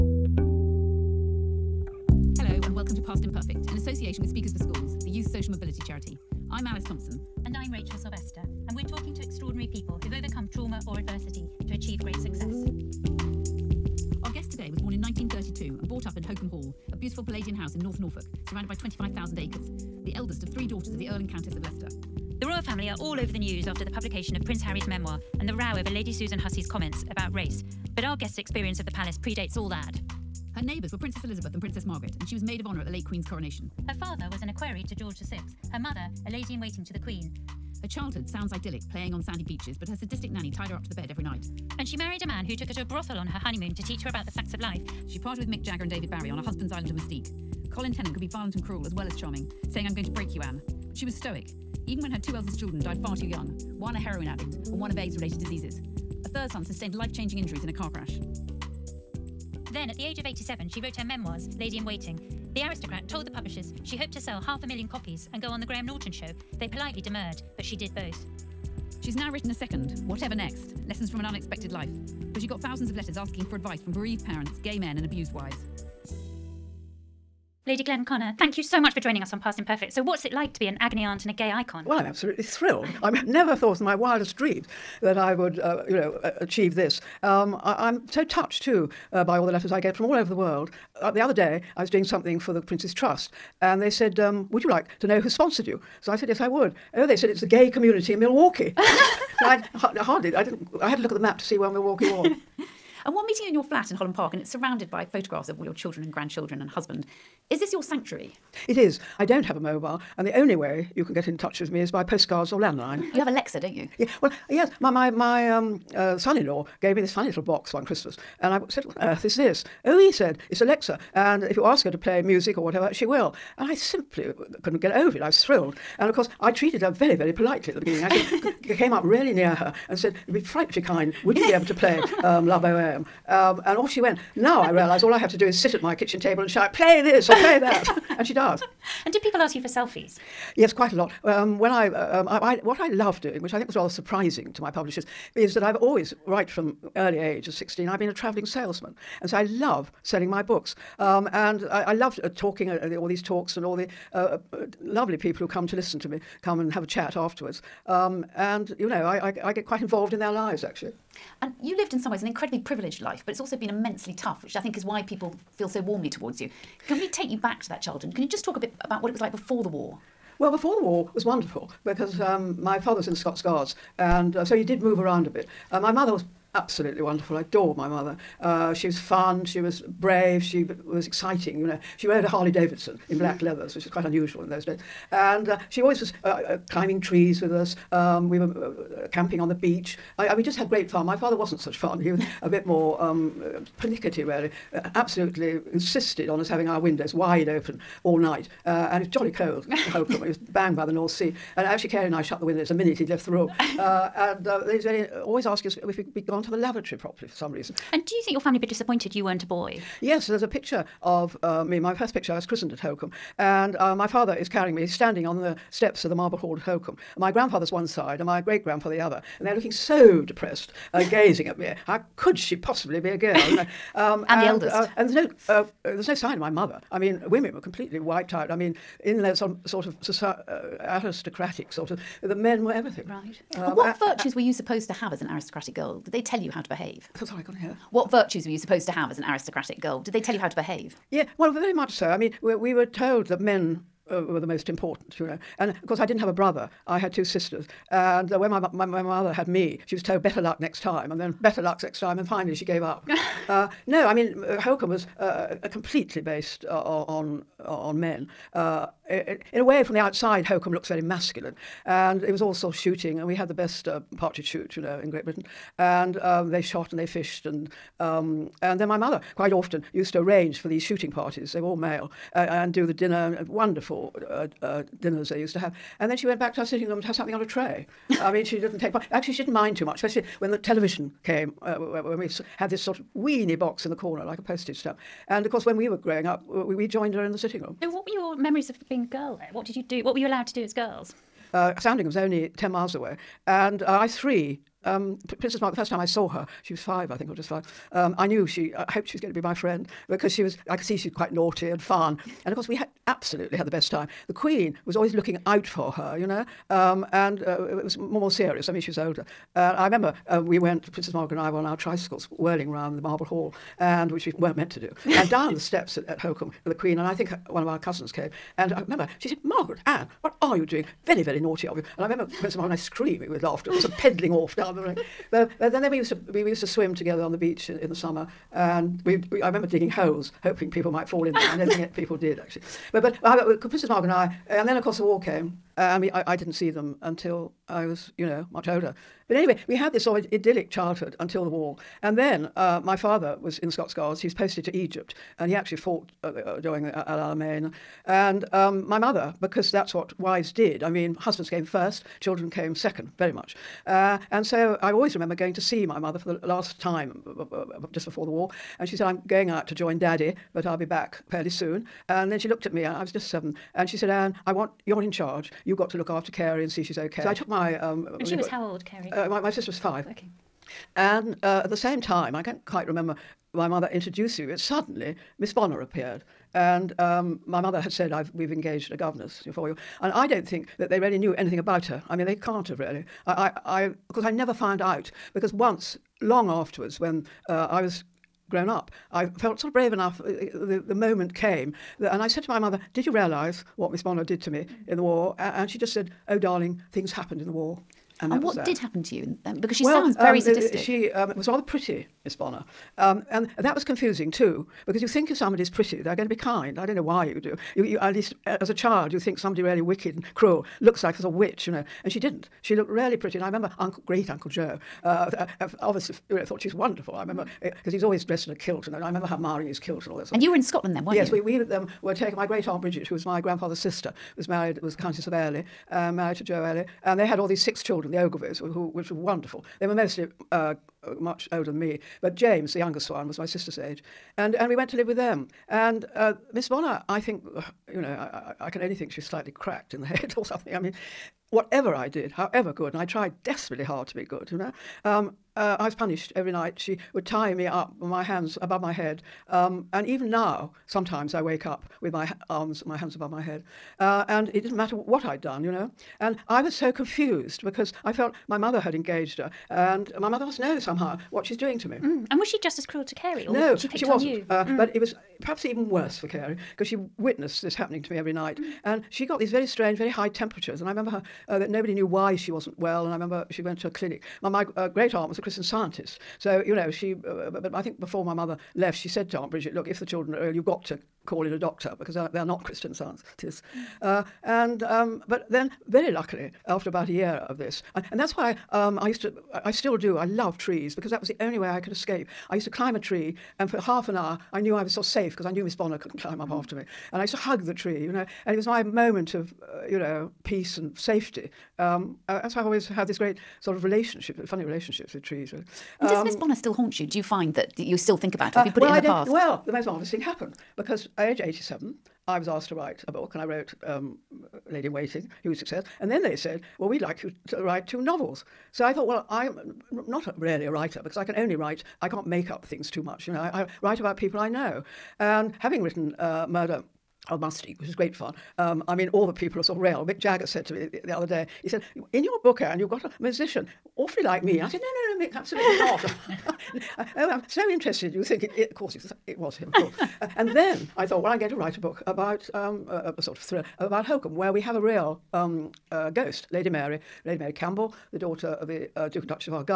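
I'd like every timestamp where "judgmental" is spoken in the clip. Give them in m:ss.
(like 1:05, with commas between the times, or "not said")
not said.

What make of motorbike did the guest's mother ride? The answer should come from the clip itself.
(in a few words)
Harley Davidson.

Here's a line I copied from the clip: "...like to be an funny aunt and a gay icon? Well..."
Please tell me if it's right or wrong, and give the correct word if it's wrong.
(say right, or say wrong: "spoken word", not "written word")
wrong: "agony", not "funny".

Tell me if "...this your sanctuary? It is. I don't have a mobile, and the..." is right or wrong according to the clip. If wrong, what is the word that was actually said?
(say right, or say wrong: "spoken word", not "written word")
right.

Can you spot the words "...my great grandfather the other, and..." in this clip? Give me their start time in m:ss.
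3:38.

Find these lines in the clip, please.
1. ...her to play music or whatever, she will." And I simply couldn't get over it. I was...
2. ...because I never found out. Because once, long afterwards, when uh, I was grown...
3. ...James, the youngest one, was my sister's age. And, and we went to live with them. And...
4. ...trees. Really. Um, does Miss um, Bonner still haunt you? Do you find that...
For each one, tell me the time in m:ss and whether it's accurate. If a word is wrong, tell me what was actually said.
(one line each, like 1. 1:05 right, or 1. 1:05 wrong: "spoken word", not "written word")
1. 2:01 right
2. 6:24 right
3. 7:12 right
4. 8:25 right.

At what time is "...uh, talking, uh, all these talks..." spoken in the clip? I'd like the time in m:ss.
2:32.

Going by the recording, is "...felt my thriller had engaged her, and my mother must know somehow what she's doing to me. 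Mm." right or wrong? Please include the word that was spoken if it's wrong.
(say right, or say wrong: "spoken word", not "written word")
wrong: "mother", not "thriller".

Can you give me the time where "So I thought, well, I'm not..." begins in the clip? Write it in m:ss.
8:38.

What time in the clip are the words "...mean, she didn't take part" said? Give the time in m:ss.
4:38.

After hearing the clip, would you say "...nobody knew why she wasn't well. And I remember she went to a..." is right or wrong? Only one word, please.
right.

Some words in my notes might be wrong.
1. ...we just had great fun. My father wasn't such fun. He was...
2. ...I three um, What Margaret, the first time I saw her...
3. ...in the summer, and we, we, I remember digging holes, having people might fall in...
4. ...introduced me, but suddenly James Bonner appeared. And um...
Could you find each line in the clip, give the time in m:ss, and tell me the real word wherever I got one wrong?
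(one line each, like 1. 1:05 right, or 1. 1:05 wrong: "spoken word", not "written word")
1. 3:10 right
2. 4:53 wrong: "Princess", not "What"
3. 5:27 wrong: "hoping", not "having"
4. 6:13 wrong: "Miss", not "James".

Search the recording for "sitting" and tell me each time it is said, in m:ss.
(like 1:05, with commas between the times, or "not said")
4:36, 4:47.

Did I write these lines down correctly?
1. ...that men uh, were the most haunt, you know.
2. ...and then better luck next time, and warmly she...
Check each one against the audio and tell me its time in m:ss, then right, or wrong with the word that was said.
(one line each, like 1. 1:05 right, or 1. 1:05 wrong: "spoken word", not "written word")
1. 4:03 wrong: "important", not "haunt"
2. 4:11 wrong: "finally", not "warmly".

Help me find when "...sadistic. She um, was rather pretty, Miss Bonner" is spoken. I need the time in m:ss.
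6:40.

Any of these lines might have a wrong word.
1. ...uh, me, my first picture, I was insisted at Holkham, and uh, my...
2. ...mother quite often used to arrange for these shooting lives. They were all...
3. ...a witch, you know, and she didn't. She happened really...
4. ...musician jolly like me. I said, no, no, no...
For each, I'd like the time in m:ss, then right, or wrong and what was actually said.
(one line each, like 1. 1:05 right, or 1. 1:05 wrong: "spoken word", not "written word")
1. 3:31 wrong: "christened", not "insisted"
2. 4:28 wrong: "parties", not "lives"
3. 6:51 wrong: "looked", not "happened"
4. 8:53 wrong: "awfully", not "jolly".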